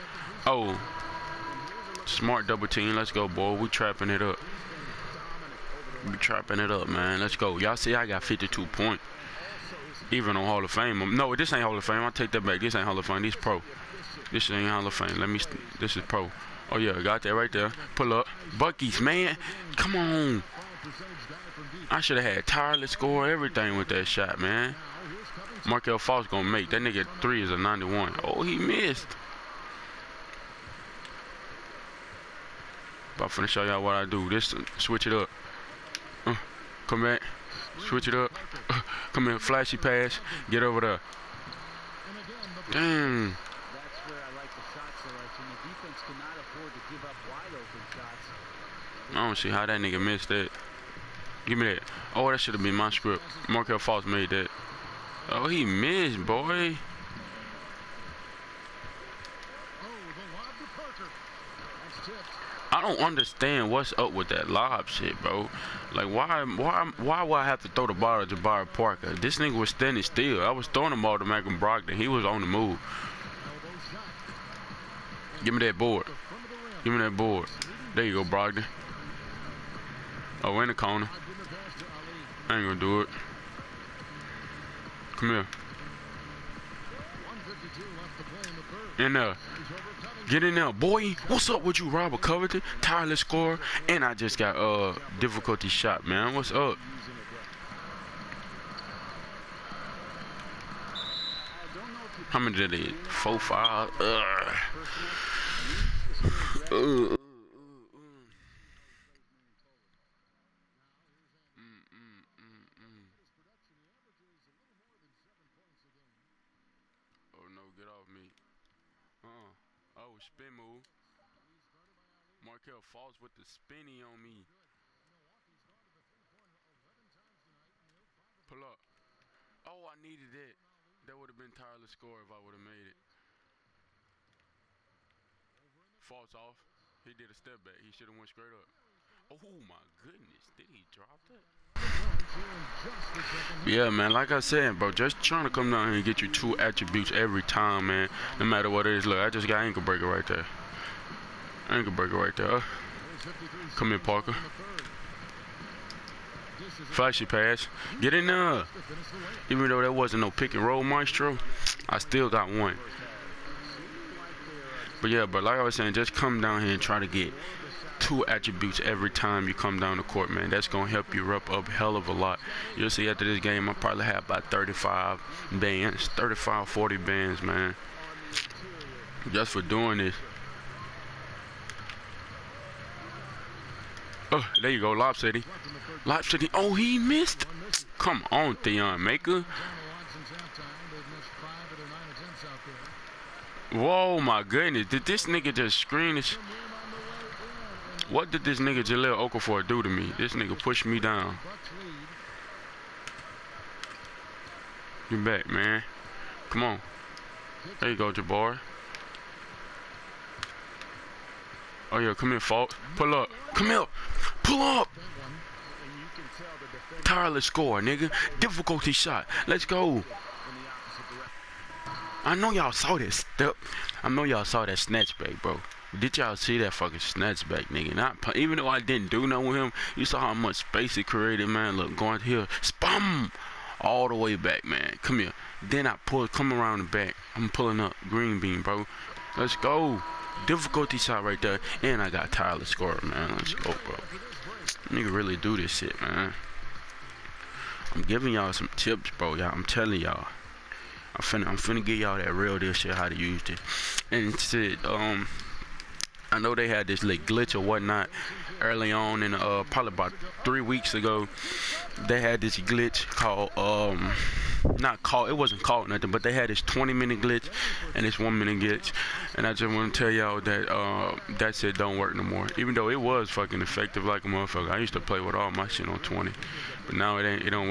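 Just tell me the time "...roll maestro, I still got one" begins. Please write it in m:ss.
2:40.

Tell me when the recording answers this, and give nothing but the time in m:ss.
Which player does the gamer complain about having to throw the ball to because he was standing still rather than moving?
1:08.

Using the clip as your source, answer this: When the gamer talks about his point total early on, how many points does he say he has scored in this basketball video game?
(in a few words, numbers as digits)
52.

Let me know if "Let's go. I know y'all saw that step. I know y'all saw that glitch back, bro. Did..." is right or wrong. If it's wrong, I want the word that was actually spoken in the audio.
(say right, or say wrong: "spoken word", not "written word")
wrong: "snatch", not "glitch".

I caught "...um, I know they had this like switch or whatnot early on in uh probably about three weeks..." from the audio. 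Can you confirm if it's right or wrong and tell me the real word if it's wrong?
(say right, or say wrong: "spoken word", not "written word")
wrong: "glitch", not "switch".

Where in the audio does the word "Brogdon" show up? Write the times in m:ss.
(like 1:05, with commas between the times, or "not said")
1:11, 1:18.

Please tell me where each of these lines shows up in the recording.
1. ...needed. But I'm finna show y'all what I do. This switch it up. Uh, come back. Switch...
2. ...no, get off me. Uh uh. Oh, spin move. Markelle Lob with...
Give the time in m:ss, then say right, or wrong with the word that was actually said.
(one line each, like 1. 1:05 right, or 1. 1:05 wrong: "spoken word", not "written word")
1. 0:28 wrong: "missed", not "needed"
2. 1:57 wrong: "Fultz", not "Lob".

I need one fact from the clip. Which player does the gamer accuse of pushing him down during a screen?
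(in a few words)
Jahlil Okafor.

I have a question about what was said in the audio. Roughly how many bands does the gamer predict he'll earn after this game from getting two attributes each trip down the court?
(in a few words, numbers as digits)
35 to 40.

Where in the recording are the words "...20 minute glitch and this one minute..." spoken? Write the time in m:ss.
4:26.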